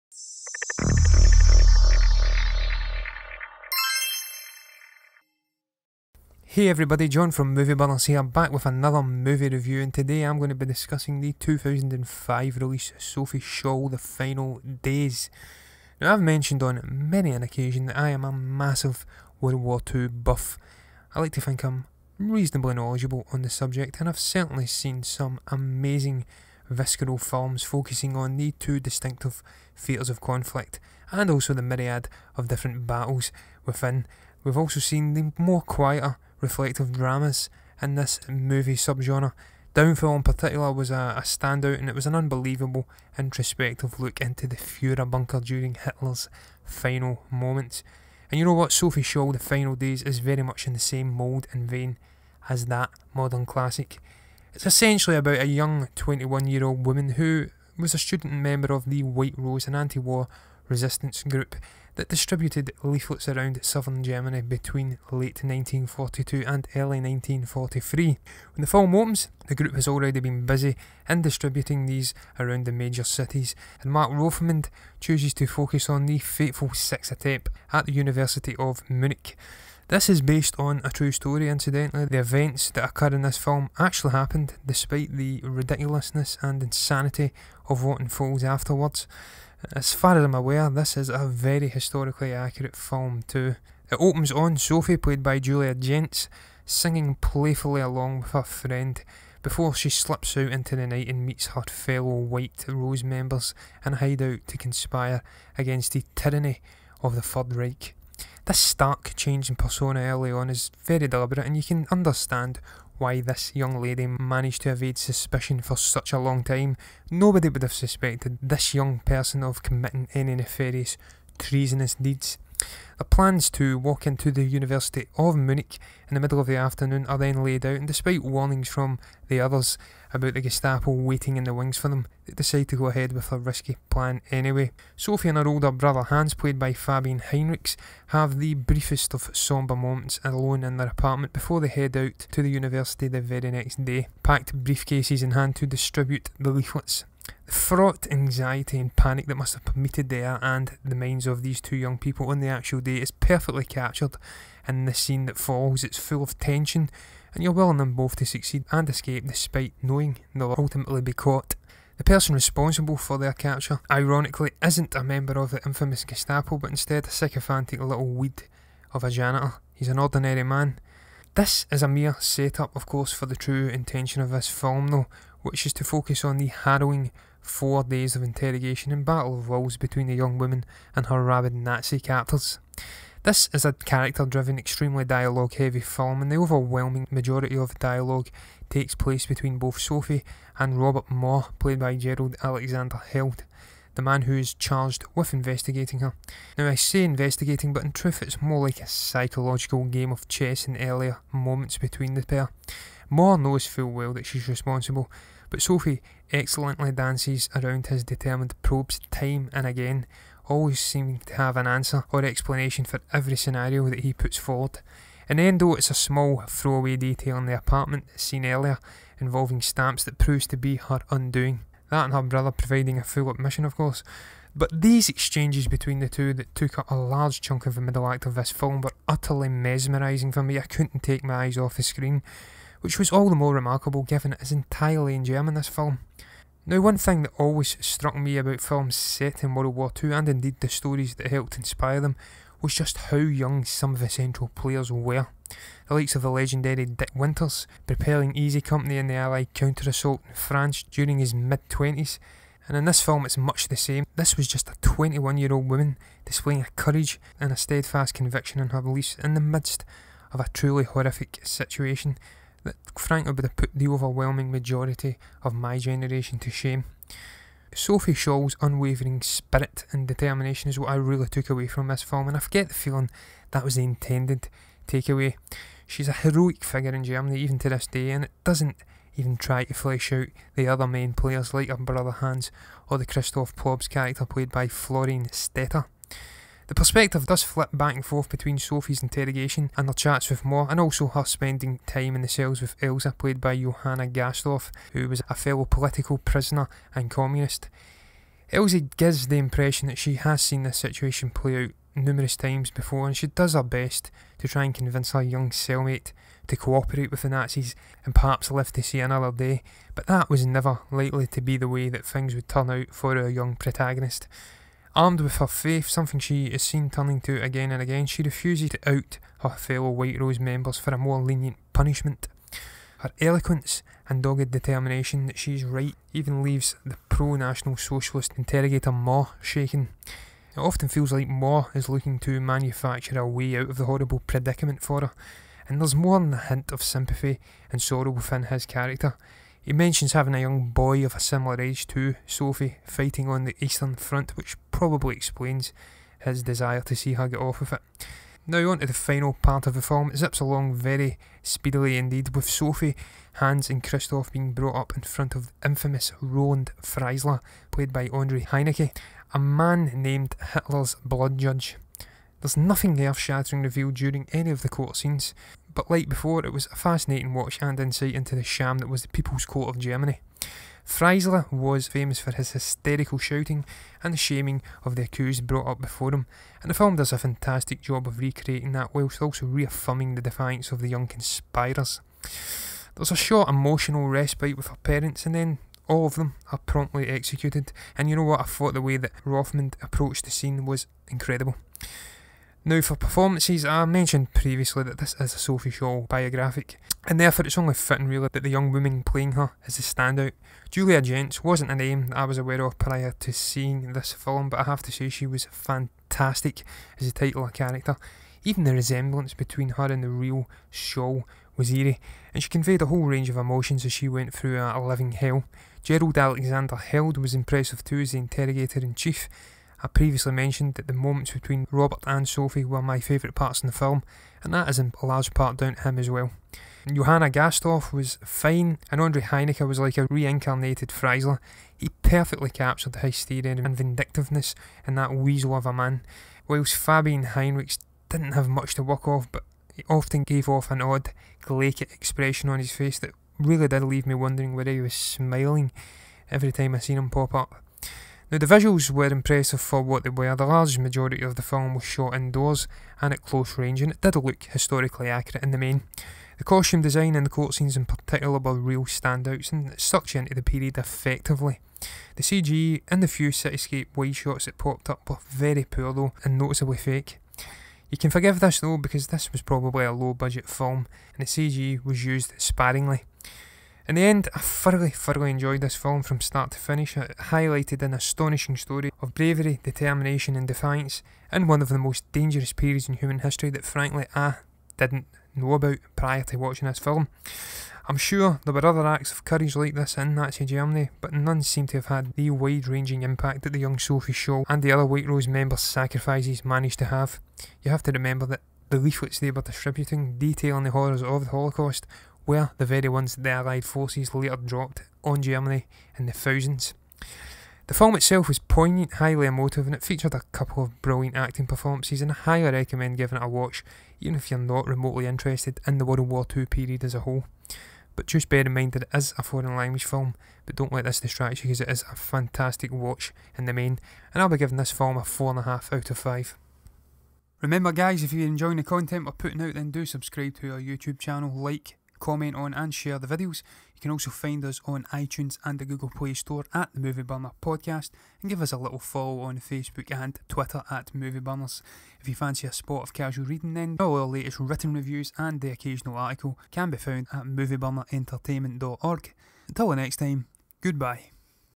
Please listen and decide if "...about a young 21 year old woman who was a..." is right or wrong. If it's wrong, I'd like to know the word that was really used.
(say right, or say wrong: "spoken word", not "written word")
right.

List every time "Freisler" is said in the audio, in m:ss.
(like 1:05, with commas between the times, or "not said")
5:56, 6:10, 7:10.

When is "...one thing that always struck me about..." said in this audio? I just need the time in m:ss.
3:56.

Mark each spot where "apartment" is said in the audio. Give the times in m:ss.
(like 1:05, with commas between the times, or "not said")
2:20, 3:37.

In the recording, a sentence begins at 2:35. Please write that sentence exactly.
It's full of tension, and you're willing them both to succeed and escape despite knowing they'll ultimately be caught.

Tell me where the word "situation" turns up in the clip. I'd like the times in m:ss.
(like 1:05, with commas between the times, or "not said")
4:21, 5:00.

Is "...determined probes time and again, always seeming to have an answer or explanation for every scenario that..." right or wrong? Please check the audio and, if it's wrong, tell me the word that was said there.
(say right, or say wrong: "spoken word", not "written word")
right.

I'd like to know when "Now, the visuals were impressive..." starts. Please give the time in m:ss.
7:28.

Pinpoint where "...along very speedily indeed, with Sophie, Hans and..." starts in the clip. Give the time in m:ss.
5:50.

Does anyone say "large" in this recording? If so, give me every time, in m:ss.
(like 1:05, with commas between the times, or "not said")
3:46, 7:05, 7:30.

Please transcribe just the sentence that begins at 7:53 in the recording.
In the end, I thoroughly, thoroughly enjoyed this film from start to finish.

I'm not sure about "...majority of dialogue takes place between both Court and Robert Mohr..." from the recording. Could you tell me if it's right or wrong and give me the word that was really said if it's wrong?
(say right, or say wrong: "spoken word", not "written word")
wrong: "Sophie", not "Court".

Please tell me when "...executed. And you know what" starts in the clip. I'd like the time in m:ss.
6:27.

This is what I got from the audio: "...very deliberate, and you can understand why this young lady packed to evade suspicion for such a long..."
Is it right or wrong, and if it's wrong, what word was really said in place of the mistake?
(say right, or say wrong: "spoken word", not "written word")
wrong: "managed", not "packed".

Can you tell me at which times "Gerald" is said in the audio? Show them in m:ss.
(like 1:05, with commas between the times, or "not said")
3:11, 6:55.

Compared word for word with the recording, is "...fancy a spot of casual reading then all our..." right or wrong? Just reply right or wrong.
right.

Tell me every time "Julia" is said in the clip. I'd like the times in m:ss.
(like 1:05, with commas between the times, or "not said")
1:35, 6:40.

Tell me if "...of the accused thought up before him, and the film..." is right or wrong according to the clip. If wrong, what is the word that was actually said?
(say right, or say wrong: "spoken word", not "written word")
wrong: "brought", not "thought".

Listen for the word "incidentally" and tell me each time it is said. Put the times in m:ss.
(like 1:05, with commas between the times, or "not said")
1:21.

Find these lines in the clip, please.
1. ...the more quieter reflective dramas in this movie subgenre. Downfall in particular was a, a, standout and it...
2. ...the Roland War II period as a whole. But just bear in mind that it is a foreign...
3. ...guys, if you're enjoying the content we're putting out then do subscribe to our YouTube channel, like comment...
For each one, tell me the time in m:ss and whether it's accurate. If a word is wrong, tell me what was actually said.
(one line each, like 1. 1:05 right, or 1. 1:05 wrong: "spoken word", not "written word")
1. 0:35 right
2. 8:35 wrong: "World", not "Roland"
3. 8:47 right.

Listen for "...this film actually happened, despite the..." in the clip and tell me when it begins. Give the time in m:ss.
1:23.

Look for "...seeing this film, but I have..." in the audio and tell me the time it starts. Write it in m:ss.
6:43.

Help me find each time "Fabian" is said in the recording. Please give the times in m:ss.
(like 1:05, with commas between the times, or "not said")
2:16, 7:16.